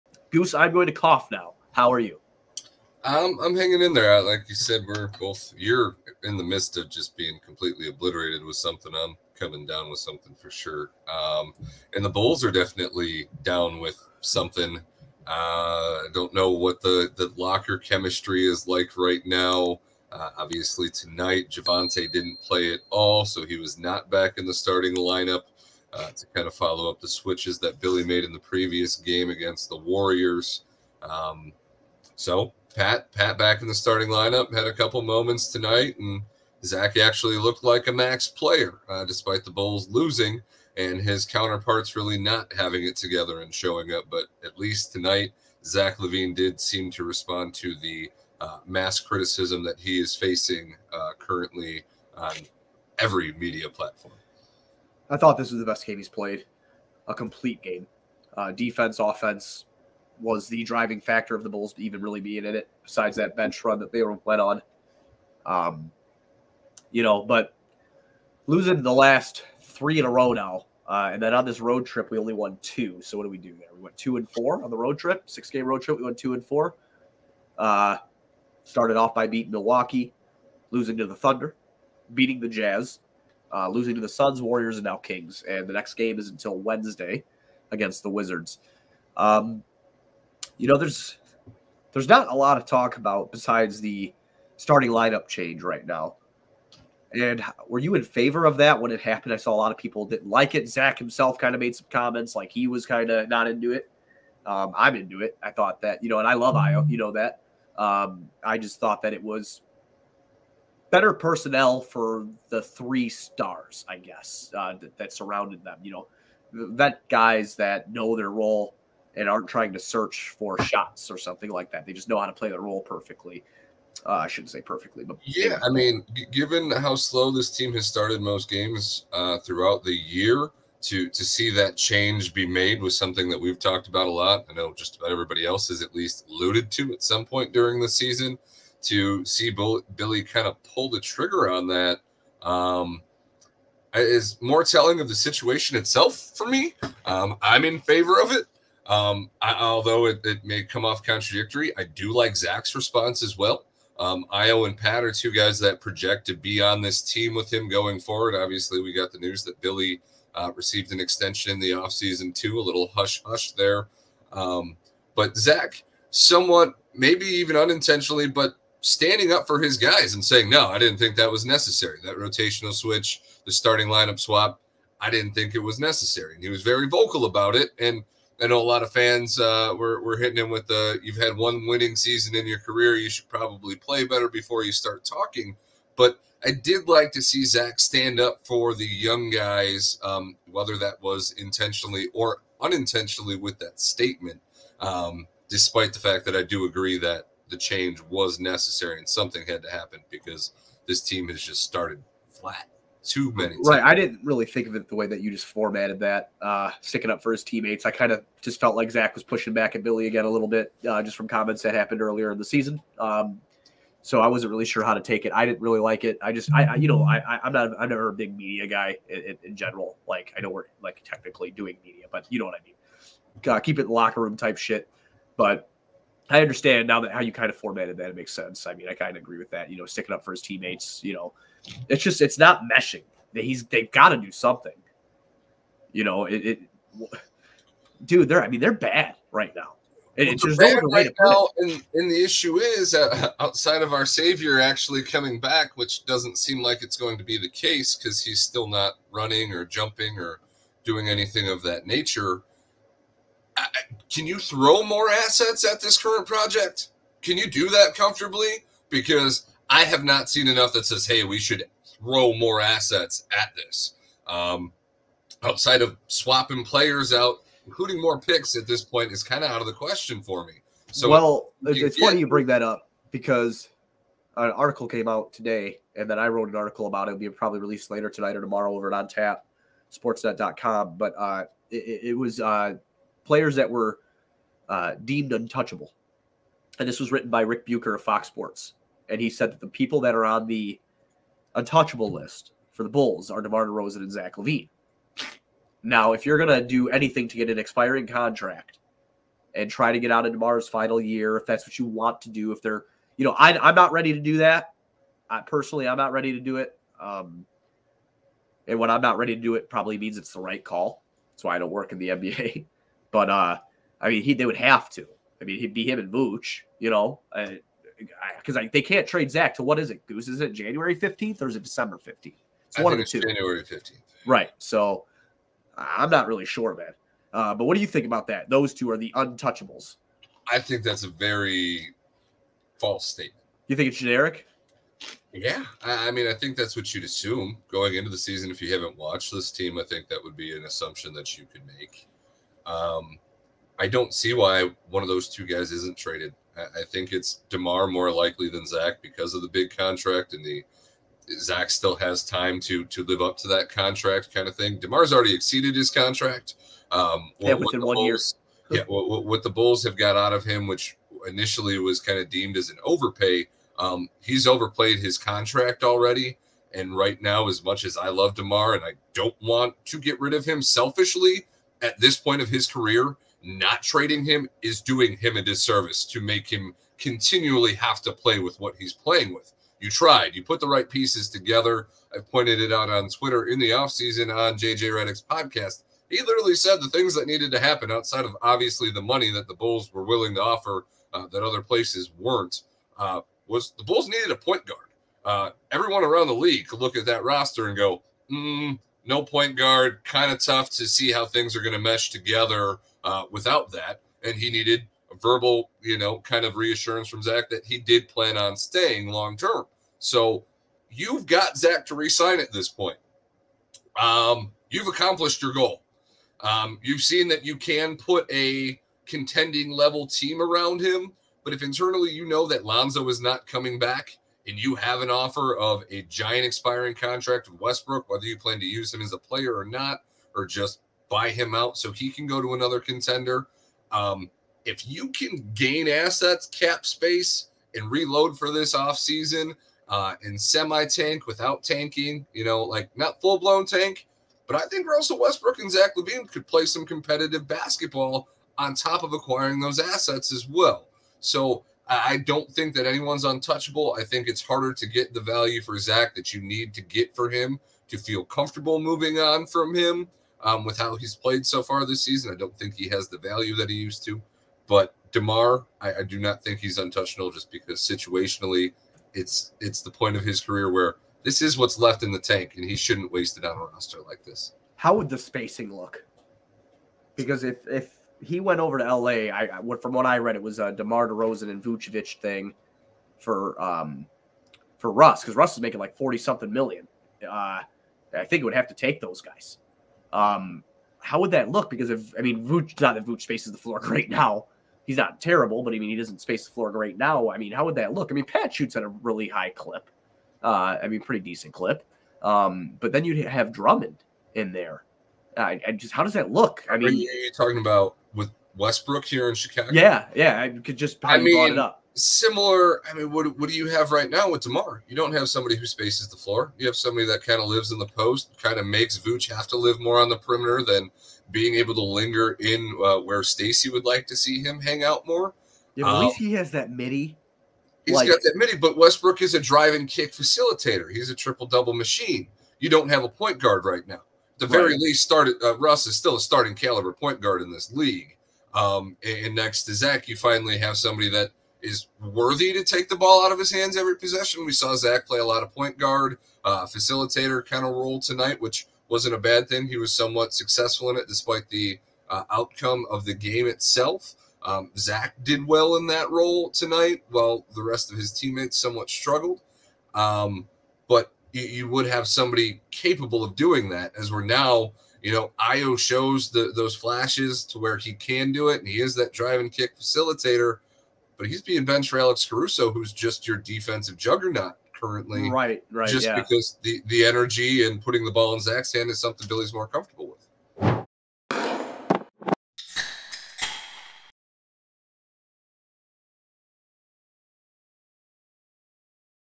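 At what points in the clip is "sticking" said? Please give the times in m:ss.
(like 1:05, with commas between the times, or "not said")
3:26, 3:49.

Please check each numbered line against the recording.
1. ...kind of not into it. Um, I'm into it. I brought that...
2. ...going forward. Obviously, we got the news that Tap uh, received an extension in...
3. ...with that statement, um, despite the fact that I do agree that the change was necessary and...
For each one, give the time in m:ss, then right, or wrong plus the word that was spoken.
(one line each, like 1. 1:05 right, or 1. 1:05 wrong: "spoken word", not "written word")
1. 1:42 wrong: "thought", not "brought"
2. 2:37 wrong: "Billy", not "Tap"
3. 3:13 right.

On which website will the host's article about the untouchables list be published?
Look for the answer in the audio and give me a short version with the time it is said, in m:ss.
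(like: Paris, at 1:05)
On Tap sportsnet.com, at 4:38.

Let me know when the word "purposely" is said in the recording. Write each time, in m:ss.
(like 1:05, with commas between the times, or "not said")
not said.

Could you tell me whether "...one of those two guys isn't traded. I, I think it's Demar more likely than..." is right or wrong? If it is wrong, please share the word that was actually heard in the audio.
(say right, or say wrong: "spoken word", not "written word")
right.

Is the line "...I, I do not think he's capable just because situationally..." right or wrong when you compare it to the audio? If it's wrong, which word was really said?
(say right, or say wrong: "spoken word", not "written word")
wrong: "untouchable", not "capable".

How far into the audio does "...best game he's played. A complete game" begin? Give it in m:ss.
0:55.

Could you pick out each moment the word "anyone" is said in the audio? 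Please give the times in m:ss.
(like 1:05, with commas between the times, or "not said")
7:32.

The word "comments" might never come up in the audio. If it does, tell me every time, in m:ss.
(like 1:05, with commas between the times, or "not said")
1:41, 3:31.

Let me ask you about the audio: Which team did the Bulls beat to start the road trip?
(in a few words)
Milwaukee.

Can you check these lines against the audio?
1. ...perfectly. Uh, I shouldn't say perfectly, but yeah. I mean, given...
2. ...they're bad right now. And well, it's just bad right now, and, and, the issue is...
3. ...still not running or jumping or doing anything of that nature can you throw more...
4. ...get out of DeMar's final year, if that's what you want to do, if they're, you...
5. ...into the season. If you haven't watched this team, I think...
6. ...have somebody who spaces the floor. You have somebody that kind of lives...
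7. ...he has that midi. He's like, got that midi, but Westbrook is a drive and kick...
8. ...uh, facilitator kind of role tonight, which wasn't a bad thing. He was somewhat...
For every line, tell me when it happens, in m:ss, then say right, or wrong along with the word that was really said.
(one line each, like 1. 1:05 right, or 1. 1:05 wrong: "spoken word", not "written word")
1. 2:02 right
2. 3:58 right
3. 4:08 right
4. 4:59 right
5. 5:37 right
6. 8:35 right
7. 8:46 right
8. 9:06 right.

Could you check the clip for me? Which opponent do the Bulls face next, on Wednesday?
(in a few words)
Wizards.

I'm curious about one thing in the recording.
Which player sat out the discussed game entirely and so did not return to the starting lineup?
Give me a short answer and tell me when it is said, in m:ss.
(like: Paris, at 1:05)
Javonte, at 0:21.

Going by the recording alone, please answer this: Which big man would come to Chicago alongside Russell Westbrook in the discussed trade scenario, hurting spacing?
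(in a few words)
Drummond.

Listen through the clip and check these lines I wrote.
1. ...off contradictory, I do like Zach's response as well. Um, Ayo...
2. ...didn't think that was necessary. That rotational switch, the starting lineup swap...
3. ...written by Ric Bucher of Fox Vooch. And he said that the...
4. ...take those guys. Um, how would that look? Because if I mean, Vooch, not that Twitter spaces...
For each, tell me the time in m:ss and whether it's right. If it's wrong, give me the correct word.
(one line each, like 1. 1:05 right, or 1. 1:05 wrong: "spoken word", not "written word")
1. 2:30 right
2. 2:50 right
3. 4:47 wrong: "Sports", not "Vooch"
4. 8:08 wrong: "Vooch", not "Twitter".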